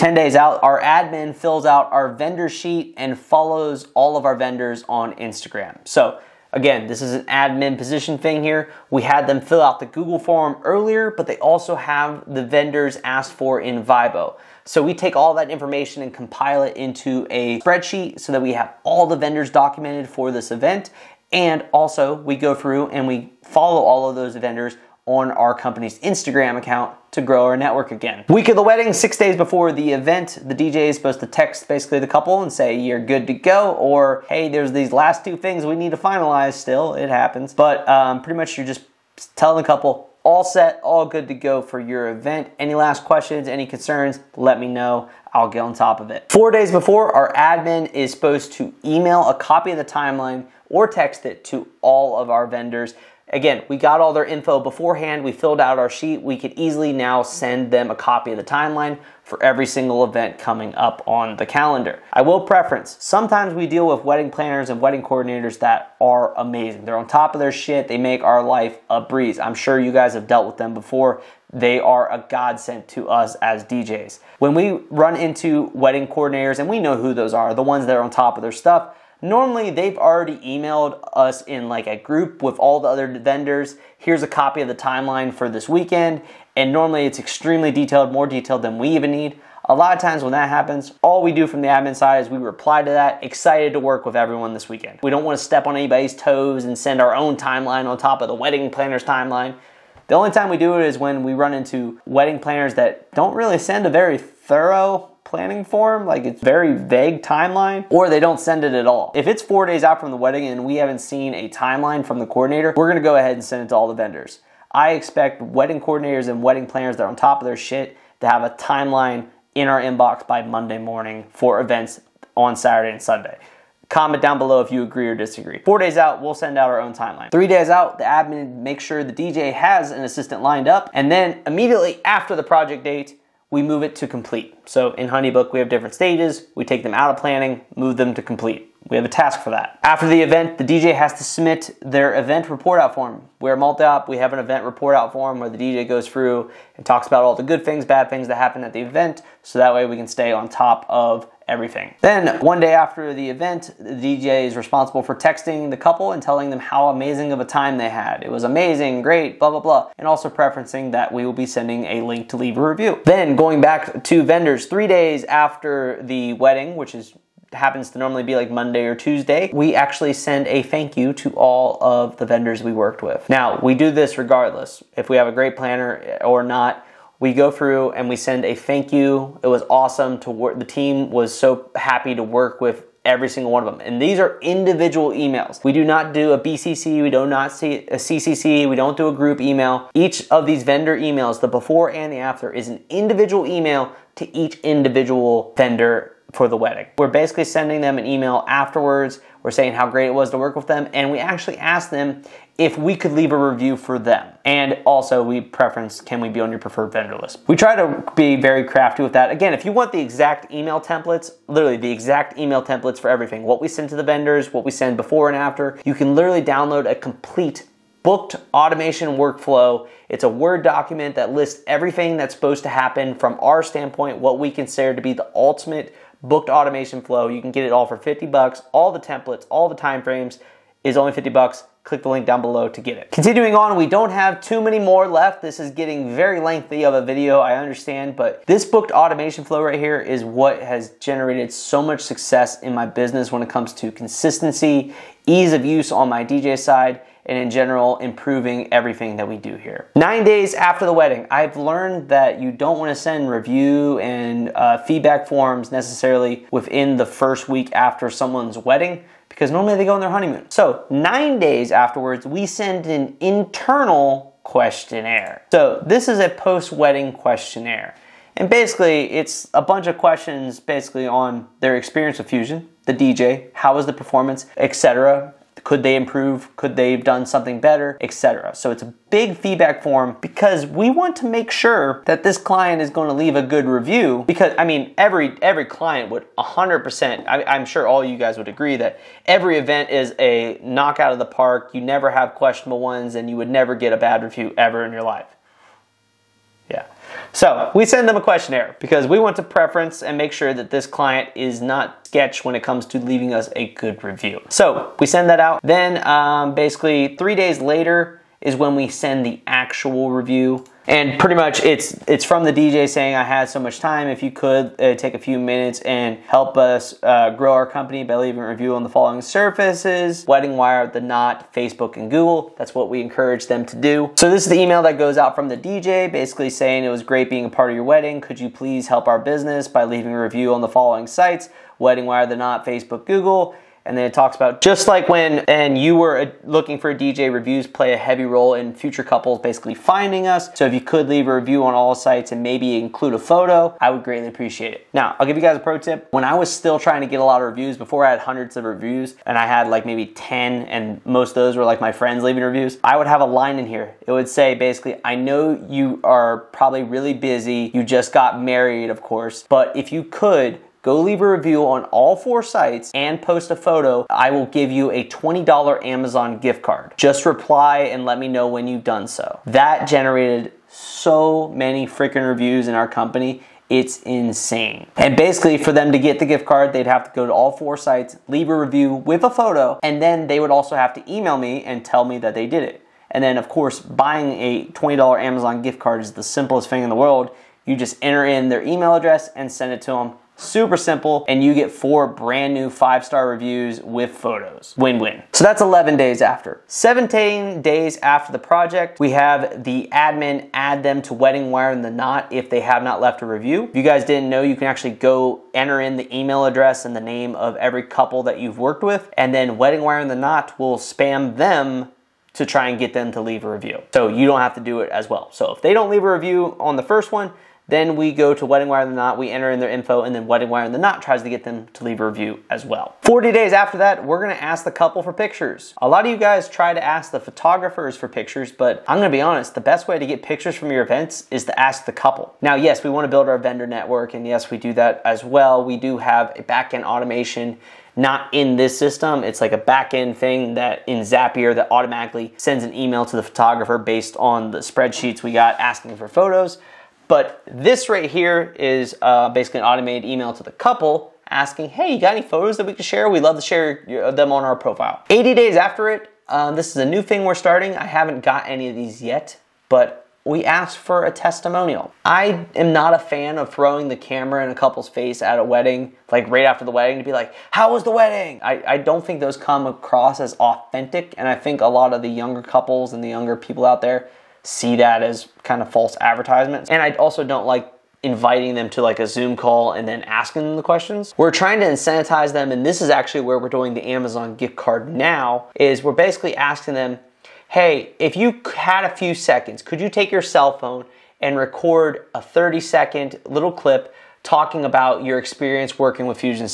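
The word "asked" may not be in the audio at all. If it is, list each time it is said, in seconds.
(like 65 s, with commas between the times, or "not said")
13 s, 201 s, 460 s.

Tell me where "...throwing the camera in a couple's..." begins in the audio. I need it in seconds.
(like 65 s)
463 s.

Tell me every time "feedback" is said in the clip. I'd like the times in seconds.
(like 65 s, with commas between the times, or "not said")
254 s, 279 s.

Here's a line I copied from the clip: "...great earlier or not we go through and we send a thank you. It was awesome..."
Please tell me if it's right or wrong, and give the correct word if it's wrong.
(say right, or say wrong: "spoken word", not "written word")
wrong: "planner", not "earlier".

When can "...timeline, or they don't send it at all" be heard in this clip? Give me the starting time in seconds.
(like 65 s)
107 s.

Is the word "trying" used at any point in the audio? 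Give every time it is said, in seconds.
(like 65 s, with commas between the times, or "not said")
346 s, 481 s.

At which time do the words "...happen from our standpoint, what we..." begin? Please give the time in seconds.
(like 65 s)
222 s.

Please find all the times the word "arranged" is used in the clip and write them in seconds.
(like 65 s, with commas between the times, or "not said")
not said.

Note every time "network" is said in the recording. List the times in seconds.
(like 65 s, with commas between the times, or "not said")
27 s, 433 s.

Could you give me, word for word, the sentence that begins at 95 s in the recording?
We don't want to step on anybody's toes and send our own timeline on top of the wedding planner's timeline.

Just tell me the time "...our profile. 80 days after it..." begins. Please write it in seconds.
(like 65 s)
454 s.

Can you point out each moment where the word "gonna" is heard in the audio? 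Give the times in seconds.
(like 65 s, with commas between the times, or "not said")
112 s, 424 s, 428 s.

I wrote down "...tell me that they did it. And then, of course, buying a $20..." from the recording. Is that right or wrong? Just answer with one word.
right.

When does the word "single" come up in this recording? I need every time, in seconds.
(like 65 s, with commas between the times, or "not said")
59 s, 183 s.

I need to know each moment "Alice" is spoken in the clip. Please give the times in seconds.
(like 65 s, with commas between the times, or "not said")
not said.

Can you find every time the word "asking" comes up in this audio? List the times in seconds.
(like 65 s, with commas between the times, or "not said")
445 s, 451 s, 480 s, 486 s.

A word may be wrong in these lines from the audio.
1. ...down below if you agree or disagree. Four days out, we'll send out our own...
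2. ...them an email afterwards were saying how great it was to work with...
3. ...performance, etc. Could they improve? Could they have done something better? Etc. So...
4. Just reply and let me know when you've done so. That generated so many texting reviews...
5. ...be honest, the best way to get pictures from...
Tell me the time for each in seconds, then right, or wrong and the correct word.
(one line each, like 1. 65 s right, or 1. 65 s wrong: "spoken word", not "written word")
1. 124 s right
2. 197 s right
3. 273 s right
4. 366 s wrong: "freaking", not "texting"
5. 429 s right.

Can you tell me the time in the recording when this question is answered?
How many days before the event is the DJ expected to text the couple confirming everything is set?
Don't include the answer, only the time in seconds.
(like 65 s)
28 s.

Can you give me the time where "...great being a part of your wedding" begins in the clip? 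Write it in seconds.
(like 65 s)
327 s.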